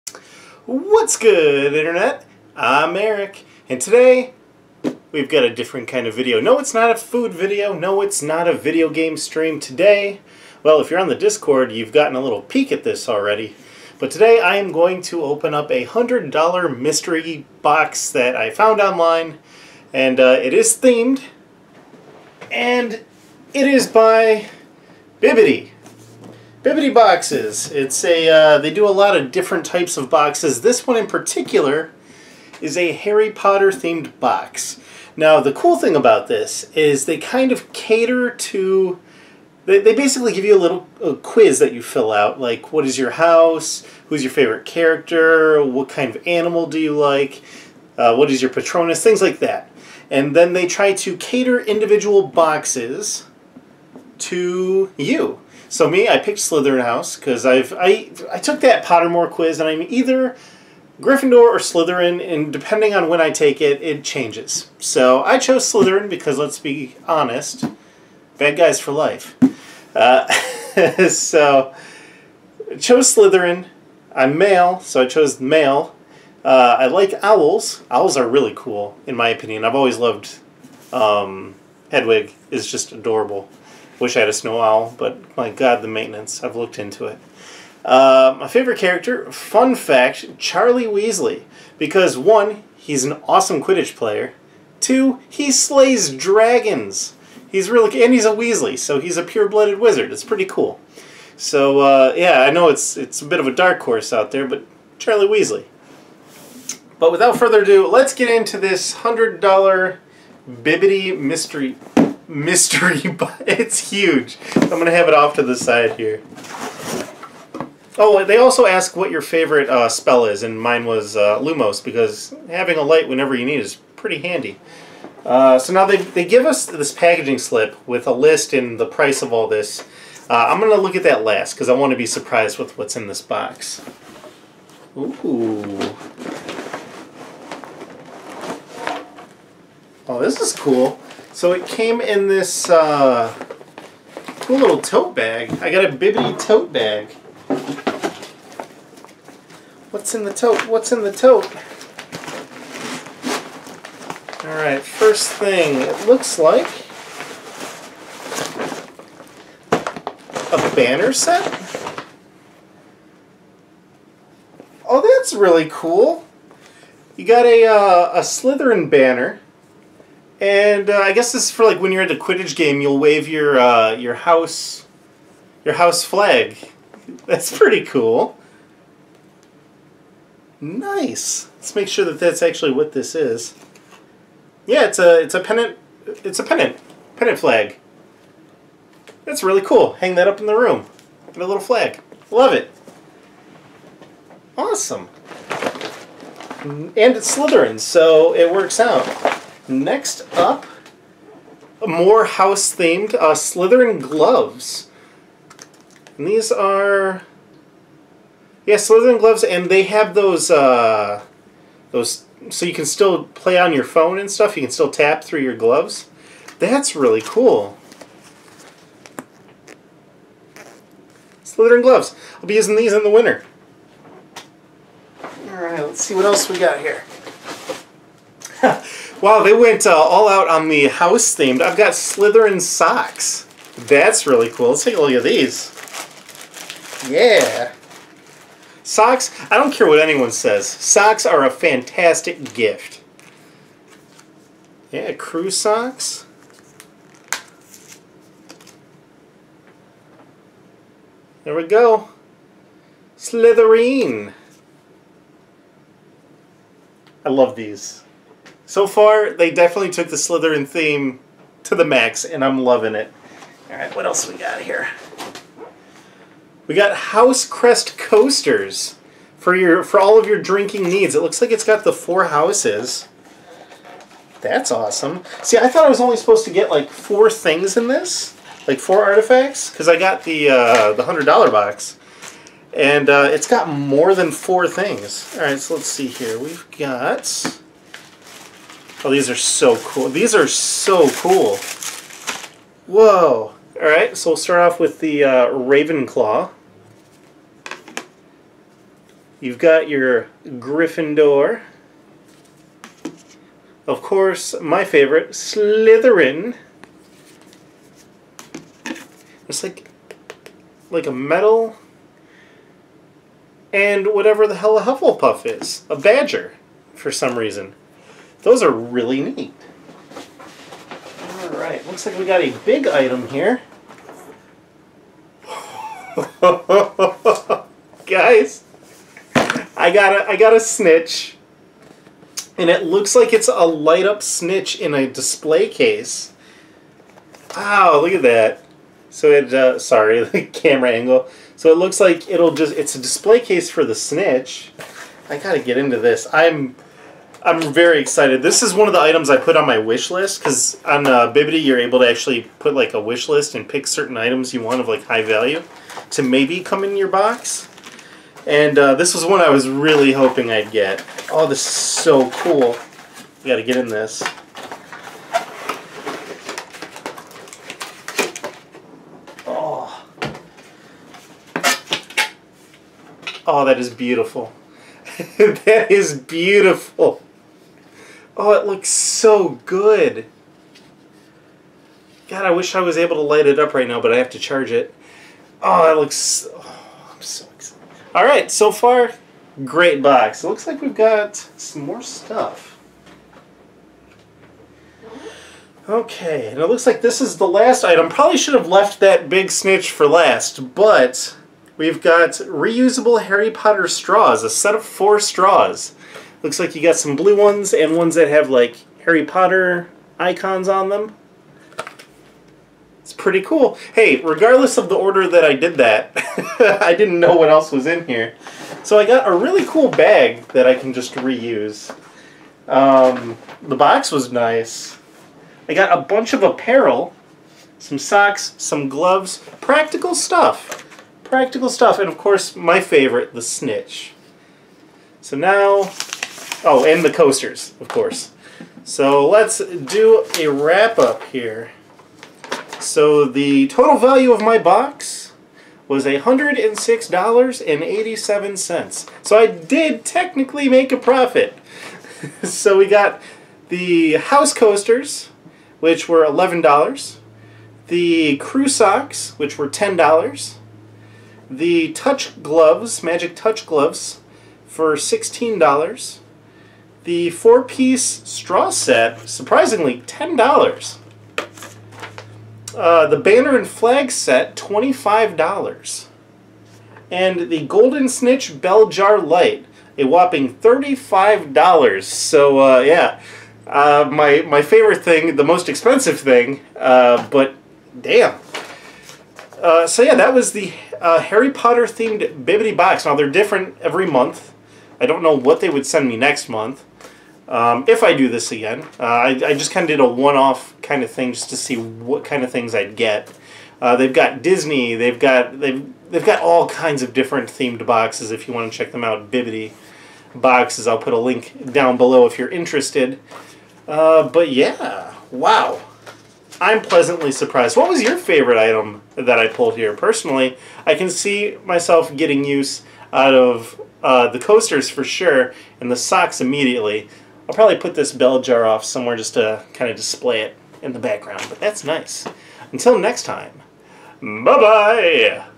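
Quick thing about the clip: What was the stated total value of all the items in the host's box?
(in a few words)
$106.87.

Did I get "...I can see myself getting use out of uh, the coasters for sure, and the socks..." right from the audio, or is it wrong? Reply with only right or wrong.
right.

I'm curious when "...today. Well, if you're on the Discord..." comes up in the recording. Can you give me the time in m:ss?
0:09.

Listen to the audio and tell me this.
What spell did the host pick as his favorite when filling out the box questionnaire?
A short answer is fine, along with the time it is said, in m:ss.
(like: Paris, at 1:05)
Lumos, at 2:01.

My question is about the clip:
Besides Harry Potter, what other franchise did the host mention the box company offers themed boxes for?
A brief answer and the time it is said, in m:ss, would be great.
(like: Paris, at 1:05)
Disney, at 8:24.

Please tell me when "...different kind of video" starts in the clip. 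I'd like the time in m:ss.
0:05.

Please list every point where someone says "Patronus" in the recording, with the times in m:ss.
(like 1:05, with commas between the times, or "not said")
0:48.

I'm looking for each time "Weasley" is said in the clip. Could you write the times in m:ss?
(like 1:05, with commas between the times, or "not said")
1:30, 1:38, 1:45.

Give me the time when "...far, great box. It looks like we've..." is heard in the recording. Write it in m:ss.
6:28.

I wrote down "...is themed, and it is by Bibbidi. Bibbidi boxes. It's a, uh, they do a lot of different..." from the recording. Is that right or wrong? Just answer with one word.
right.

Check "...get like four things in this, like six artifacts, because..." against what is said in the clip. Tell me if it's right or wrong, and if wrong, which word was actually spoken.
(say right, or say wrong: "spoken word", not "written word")
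wrong: "four", not "six".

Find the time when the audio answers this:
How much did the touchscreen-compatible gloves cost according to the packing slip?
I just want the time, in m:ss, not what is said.
7:44.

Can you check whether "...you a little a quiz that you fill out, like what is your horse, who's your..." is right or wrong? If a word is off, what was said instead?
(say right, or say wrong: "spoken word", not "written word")
wrong: "house", not "horse".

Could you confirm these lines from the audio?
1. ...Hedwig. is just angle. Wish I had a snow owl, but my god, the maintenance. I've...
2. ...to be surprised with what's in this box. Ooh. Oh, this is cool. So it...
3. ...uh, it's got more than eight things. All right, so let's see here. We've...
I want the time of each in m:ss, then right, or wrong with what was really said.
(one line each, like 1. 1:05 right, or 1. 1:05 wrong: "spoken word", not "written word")
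1. 1:21 wrong: "adorable", not "angle"
2. 2:11 right
3. 4:43 wrong: "four", not "eight".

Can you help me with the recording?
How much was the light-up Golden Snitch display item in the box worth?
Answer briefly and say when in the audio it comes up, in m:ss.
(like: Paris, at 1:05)
$35, at 8:00.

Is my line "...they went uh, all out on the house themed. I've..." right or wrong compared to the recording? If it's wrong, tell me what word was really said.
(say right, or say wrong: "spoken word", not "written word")
right.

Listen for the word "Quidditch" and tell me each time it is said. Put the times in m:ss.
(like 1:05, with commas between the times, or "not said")
1:33, 2:52.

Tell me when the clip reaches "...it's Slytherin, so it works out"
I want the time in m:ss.
3:17.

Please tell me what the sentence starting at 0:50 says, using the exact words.
And then they try to cater individual boxes to you.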